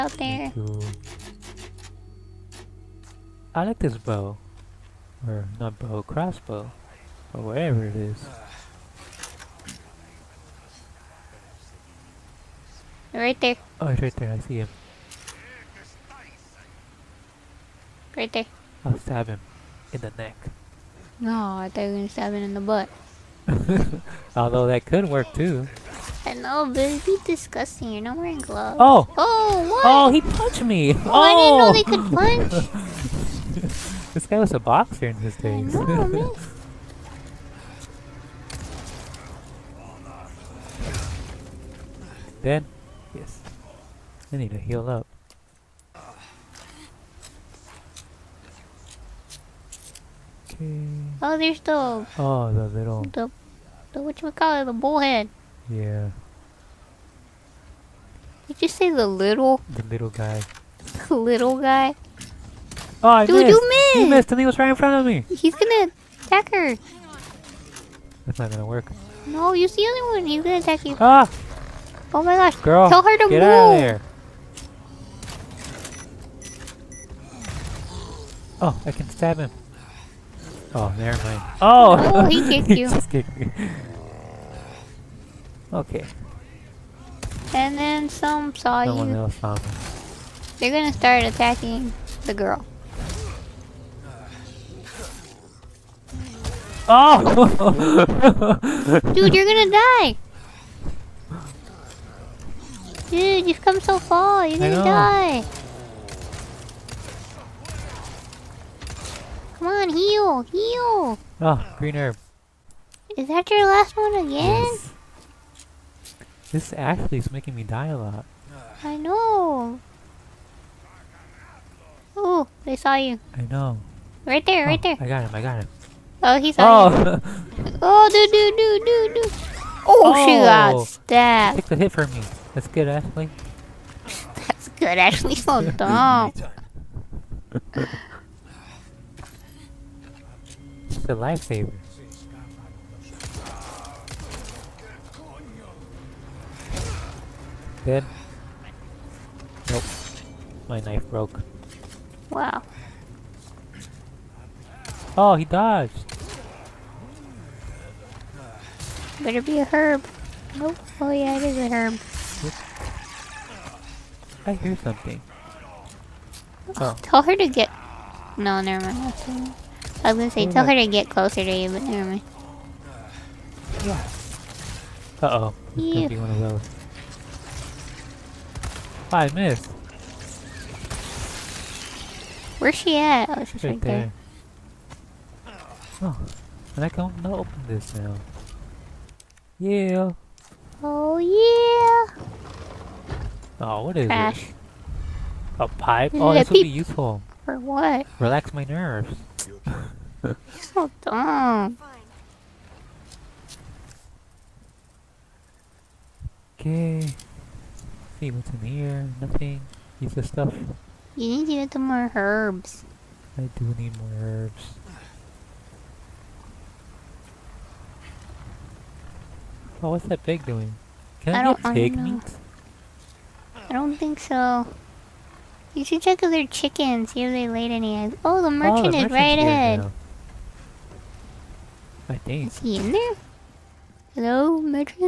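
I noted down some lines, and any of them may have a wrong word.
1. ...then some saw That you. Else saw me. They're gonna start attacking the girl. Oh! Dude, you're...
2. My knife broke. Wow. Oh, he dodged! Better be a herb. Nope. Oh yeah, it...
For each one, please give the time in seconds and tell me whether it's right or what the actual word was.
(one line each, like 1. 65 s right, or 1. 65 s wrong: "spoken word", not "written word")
1. 87 s wrong: "Someone", not "That"
2. 150 s right.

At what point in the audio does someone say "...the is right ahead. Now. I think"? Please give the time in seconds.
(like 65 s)
228 s.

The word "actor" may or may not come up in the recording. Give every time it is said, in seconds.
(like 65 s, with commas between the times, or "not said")
not said.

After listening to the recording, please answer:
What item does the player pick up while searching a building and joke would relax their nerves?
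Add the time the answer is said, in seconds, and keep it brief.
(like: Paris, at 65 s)
pipe, at 195 s.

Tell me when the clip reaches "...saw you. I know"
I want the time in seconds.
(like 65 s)
122 s.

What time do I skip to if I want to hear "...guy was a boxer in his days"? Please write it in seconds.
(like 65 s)
34 s.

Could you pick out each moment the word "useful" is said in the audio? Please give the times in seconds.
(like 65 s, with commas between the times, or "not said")
196 s.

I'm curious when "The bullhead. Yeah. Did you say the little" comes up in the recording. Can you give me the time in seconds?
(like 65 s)
54 s.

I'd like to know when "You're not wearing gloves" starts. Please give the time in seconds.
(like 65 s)
27 s.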